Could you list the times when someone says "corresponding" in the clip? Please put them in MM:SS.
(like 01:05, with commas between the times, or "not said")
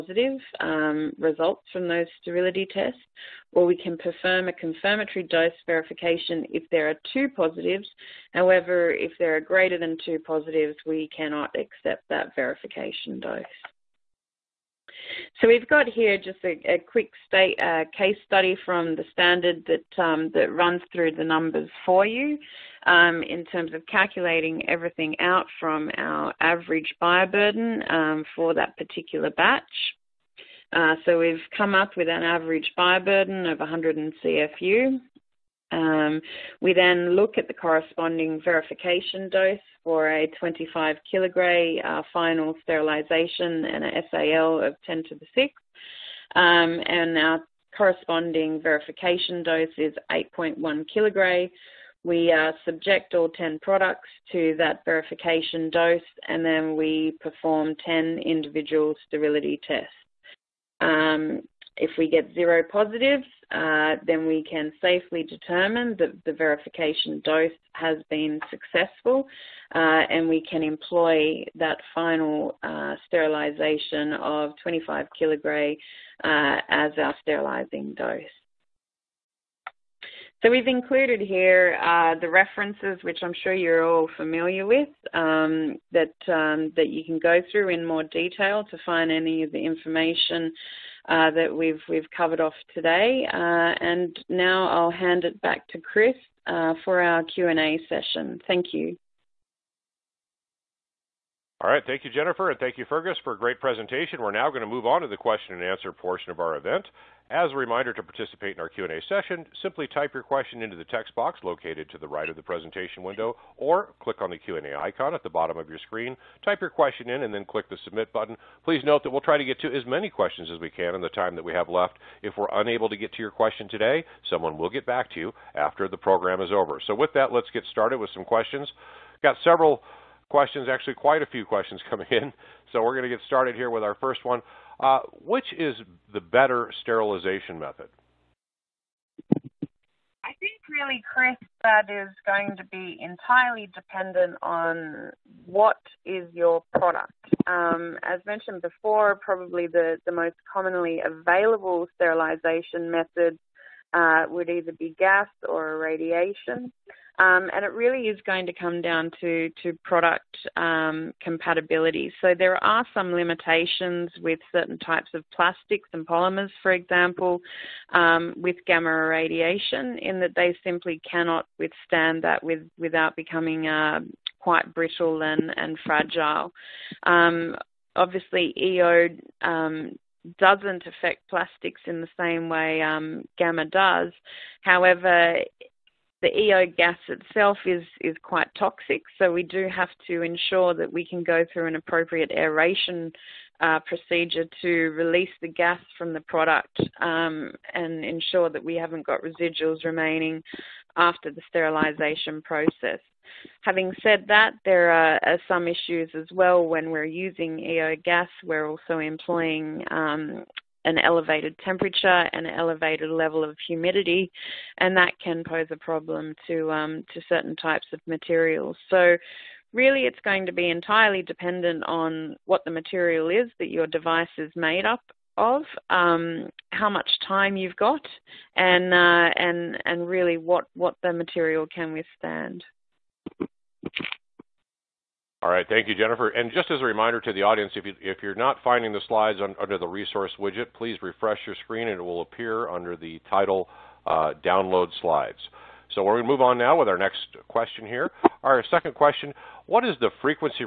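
00:37, 00:47.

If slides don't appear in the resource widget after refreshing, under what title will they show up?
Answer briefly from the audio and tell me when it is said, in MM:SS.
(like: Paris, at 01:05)
Download Slides, at 04:04.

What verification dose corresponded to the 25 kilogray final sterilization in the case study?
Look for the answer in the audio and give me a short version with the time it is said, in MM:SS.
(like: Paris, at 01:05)
8.1 kilogray, at 00:50.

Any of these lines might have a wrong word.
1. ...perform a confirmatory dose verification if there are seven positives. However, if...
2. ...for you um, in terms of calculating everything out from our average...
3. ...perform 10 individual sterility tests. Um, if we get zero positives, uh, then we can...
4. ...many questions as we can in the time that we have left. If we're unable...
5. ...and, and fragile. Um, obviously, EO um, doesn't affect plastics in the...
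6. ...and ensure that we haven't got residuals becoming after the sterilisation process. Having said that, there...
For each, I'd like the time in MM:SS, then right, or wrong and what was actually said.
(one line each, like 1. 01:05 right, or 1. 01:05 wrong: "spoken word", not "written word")
1. 00:03 wrong: "two", not "seven"
2. 00:21 right
3. 00:57 right
4. 01:59 right
5. 02:55 right
6. 03:17 wrong: "remaining", not "becoming".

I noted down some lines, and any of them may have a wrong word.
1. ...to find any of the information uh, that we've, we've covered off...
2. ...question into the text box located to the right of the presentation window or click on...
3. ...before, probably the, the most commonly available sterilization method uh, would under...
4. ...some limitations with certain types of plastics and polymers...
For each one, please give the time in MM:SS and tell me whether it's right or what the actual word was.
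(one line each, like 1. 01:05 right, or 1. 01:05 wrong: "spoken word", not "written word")
1. 01:28 right
2. 01:50 right
3. 02:28 wrong: "either", not "under"
4. 02:42 right.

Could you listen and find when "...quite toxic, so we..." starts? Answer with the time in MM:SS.
03:08.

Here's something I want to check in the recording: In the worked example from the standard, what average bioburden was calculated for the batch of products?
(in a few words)
100 CFU.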